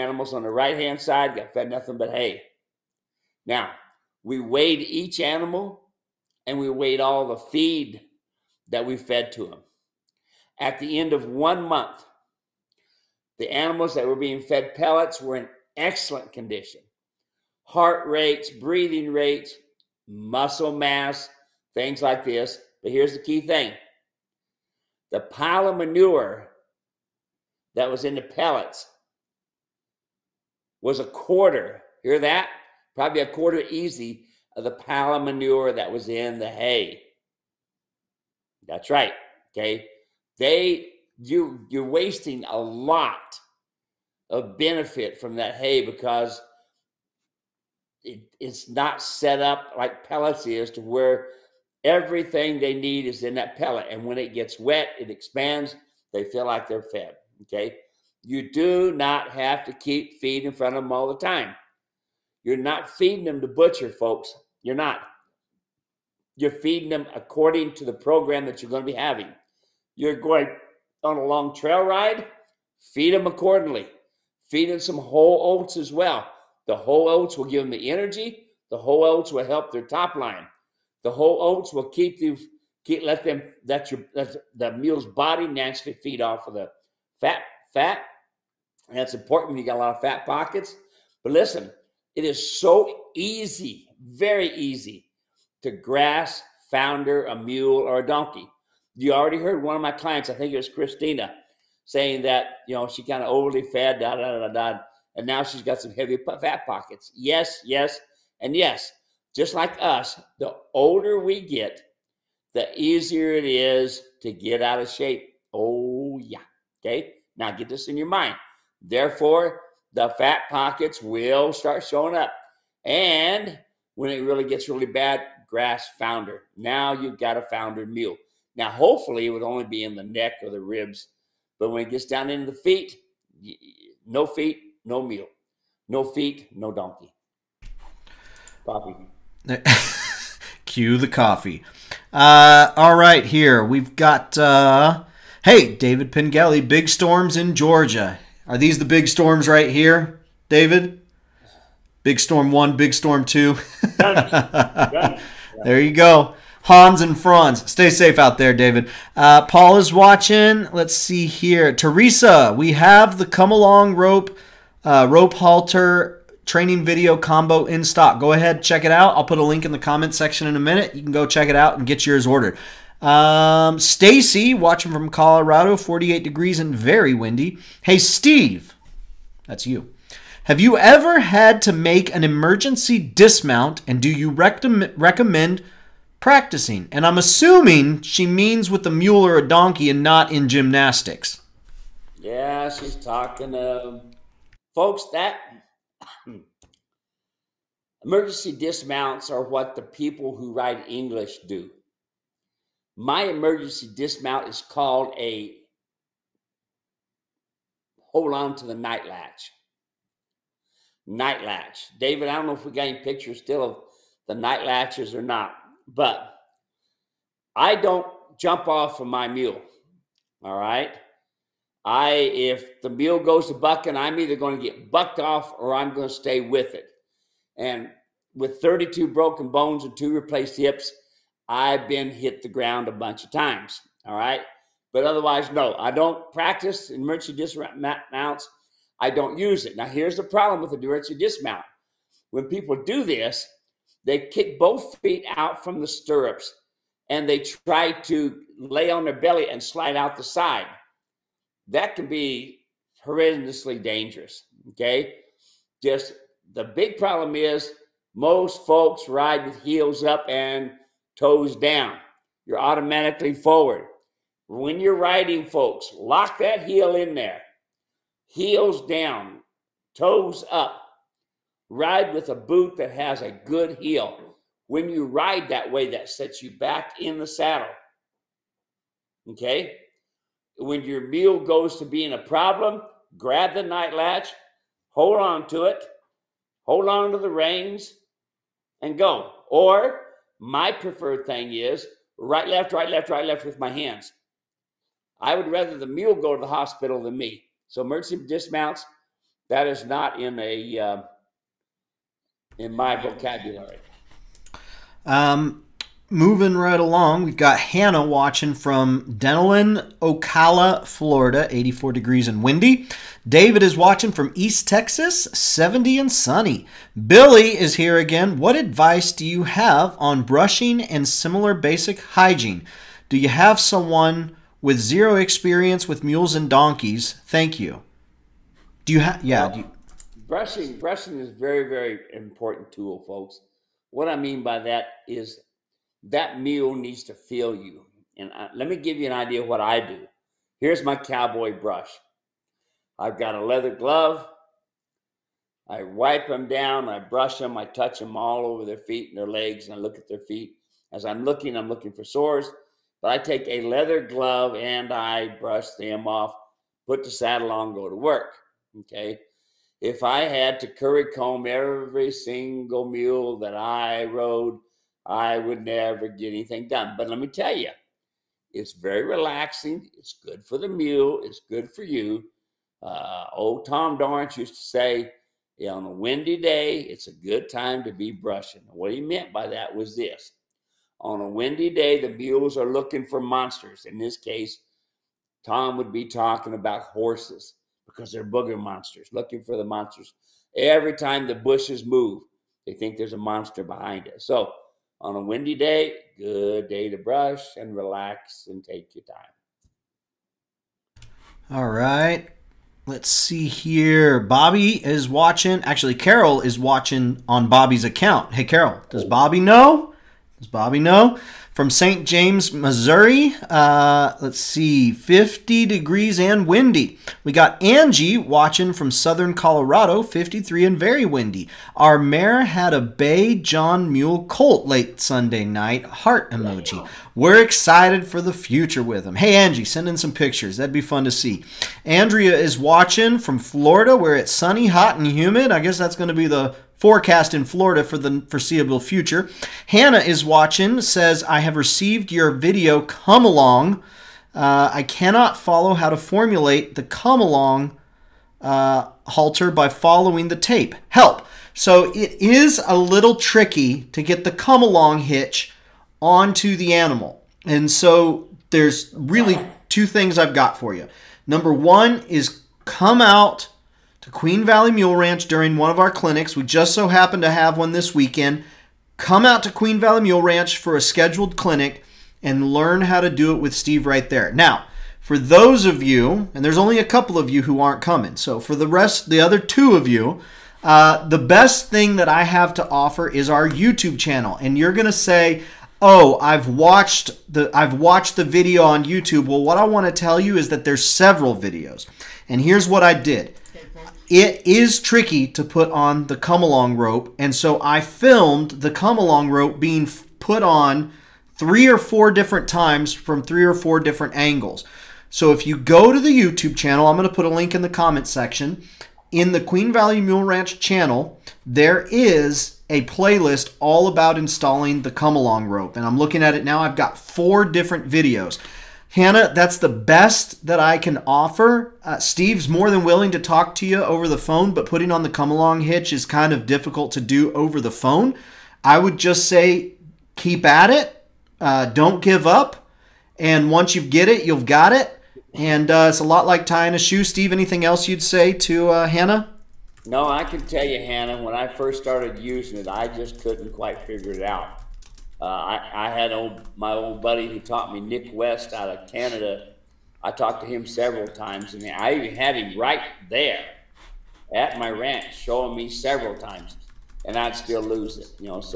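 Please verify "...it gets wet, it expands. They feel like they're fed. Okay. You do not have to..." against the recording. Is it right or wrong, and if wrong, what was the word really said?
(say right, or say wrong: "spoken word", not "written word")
right.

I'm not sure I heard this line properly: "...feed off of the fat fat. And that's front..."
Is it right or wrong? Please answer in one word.
wrong.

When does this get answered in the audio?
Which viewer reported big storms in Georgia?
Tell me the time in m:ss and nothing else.
2:25.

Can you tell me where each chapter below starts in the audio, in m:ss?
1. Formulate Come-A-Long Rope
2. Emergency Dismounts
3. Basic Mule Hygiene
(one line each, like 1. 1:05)
1. 7:19
2. 2:55
3. 5:16.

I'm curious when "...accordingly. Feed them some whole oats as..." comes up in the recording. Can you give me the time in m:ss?
1:13.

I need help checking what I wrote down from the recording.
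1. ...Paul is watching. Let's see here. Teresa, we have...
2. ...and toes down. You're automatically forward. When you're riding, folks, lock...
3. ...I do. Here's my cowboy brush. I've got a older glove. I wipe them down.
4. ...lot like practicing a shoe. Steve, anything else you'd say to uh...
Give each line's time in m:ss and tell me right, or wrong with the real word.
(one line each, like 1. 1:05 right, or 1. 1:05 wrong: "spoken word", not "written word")
1. 2:39 right
2. 4:20 right
3. 5:39 wrong: "leather", not "older"
4. 8:56 wrong: "tying", not "practicing".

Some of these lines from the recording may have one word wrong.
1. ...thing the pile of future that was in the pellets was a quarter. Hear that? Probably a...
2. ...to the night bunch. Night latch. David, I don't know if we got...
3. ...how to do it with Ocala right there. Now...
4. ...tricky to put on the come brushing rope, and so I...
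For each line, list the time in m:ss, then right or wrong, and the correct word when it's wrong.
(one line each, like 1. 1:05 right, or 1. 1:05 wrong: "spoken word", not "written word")
1. 0:23 wrong: "manure", not "future"
2. 3:28 wrong: "latch", not "bunch"
3. 7:52 wrong: "Steve", not "Ocala"
4. 8:14 wrong: "along", not "brushing".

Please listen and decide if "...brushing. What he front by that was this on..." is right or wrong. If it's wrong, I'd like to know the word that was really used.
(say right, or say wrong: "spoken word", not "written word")
wrong: "meant", not "front".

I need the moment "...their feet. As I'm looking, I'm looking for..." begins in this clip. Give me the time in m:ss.
5:50.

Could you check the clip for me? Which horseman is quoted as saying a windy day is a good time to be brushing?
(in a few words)
Tom Dorrance.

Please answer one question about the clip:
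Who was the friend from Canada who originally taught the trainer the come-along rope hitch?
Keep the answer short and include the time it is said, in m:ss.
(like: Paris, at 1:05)
Nick West, at 9:07.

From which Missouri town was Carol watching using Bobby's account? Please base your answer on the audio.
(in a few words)
St. James.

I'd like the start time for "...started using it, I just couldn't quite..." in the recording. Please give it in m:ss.
9:01.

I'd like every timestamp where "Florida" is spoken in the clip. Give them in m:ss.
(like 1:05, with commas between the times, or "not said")
5:10, 7:13, 7:17.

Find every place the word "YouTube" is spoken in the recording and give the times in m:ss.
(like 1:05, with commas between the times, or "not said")
8:03, 8:08, 8:26.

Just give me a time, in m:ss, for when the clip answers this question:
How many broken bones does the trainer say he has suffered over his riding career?
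3:48.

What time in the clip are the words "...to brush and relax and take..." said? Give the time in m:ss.
6:36.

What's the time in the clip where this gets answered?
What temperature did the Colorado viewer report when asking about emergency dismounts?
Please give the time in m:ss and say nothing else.
2:55.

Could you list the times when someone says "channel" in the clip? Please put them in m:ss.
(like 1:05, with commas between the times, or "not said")
8:03, 8:26, 8:30.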